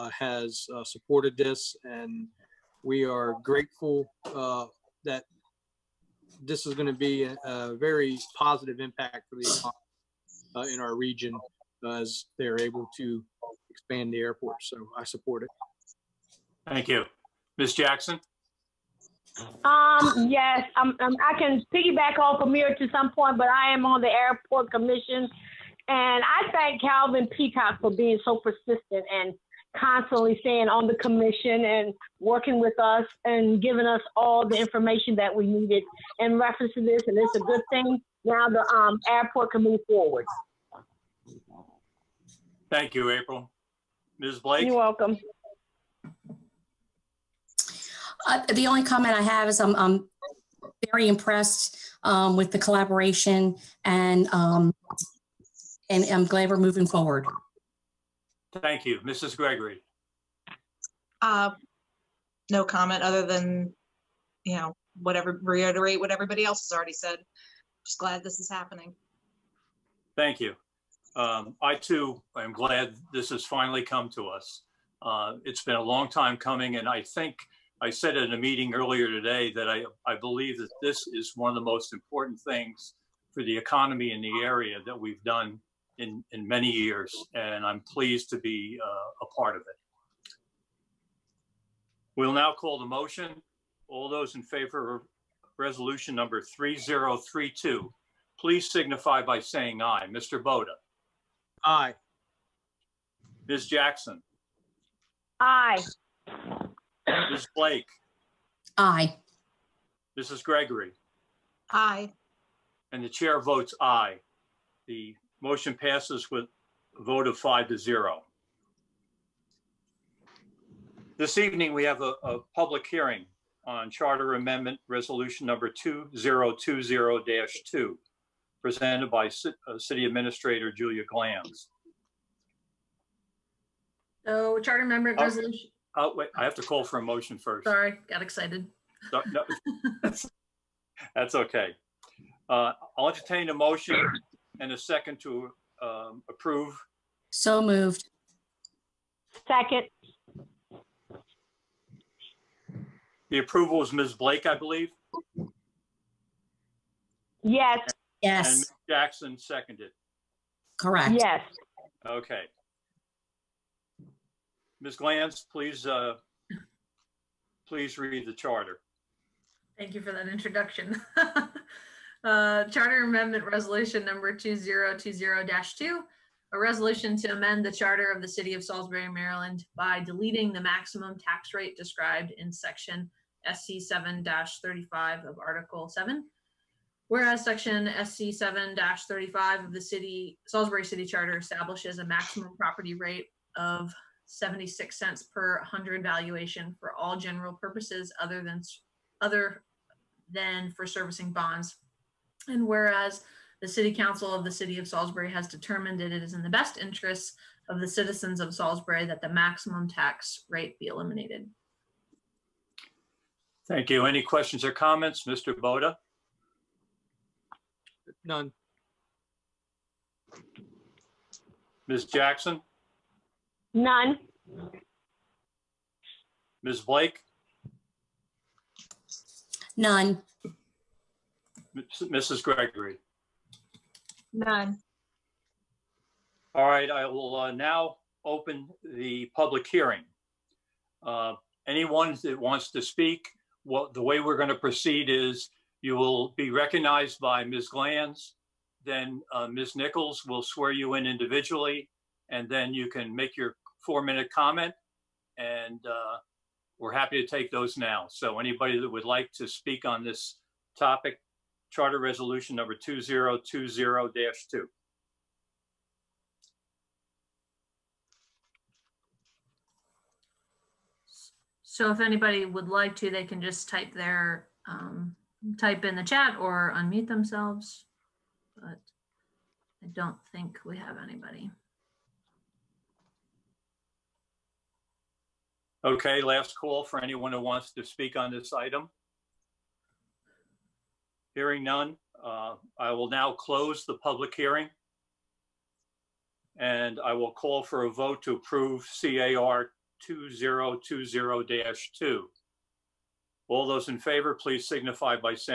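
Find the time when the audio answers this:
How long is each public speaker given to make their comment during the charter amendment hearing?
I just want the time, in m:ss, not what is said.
4:13.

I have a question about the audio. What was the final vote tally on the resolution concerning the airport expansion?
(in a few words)
5 to 0.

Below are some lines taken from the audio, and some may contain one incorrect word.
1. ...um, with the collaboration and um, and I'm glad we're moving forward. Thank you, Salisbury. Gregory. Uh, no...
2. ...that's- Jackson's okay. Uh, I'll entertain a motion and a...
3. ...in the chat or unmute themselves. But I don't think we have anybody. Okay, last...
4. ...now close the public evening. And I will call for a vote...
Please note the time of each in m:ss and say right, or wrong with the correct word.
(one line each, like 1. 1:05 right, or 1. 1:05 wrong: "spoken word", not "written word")
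1. 0:52 wrong: "Mrs", not "Salisbury"
2. 2:20 wrong: "That", not "Jackson"
3. 4:35 right
4. 4:53 wrong: "hearing", not "evening".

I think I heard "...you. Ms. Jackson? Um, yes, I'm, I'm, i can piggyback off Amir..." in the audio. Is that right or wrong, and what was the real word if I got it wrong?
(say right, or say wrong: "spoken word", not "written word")
right.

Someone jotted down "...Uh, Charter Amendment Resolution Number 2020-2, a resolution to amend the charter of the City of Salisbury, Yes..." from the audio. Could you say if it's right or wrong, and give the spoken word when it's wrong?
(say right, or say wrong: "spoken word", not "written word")
wrong: "Maryland", not "Yes".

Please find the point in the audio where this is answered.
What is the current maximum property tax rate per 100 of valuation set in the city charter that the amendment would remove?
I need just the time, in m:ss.
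3:14.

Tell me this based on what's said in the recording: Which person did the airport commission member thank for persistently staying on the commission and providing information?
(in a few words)
Calvin Peacock.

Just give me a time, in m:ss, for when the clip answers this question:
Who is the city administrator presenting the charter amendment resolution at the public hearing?
2:10.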